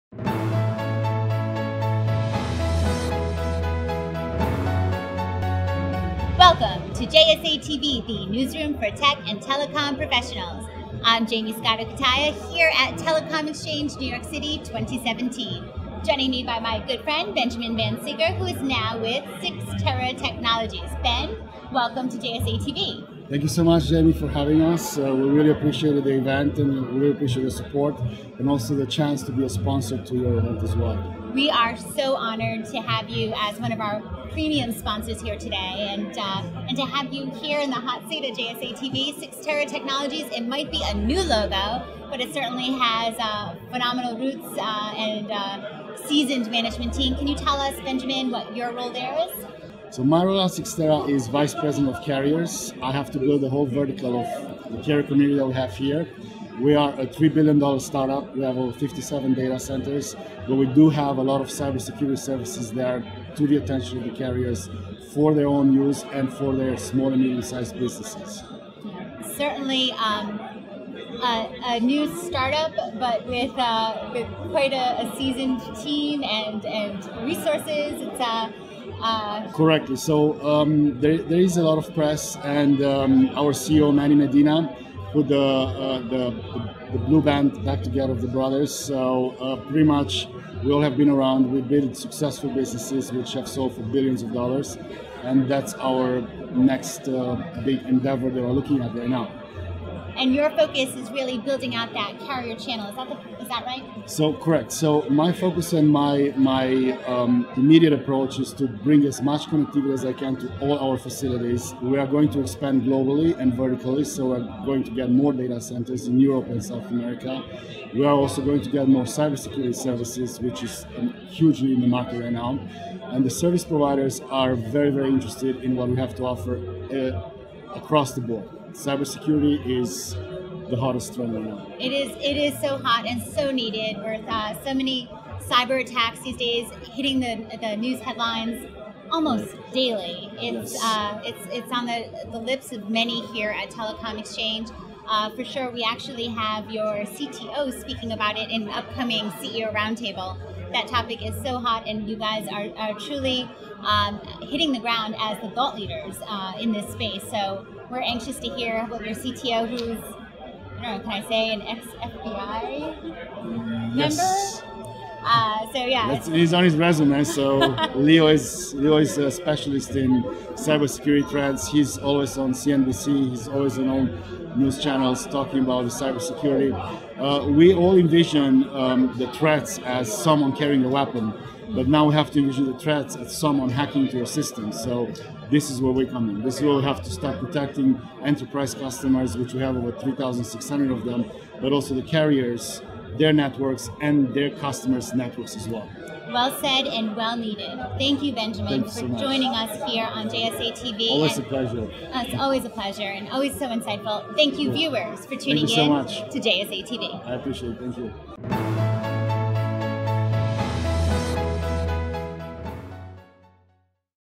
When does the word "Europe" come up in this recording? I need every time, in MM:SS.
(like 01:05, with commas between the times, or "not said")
01:56.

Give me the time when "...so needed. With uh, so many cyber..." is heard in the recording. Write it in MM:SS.
02:13.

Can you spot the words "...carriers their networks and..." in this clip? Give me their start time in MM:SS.
03:12.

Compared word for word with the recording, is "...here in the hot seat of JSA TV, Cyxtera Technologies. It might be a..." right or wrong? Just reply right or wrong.
right.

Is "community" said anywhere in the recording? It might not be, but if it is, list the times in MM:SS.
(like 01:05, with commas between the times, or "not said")
00:55.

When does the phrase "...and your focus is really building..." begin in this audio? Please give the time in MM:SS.
01:40.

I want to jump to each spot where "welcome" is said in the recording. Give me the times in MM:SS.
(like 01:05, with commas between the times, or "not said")
00:06, 00:21.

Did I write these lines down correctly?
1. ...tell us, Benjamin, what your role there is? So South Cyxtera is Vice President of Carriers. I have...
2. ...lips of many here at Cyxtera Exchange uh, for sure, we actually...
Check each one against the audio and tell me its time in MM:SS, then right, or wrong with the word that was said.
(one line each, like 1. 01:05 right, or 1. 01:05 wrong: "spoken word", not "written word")
1. 00:47 wrong: "Marula", not "South"
2. 02:22 wrong: "Telecom", not "Cyxtera".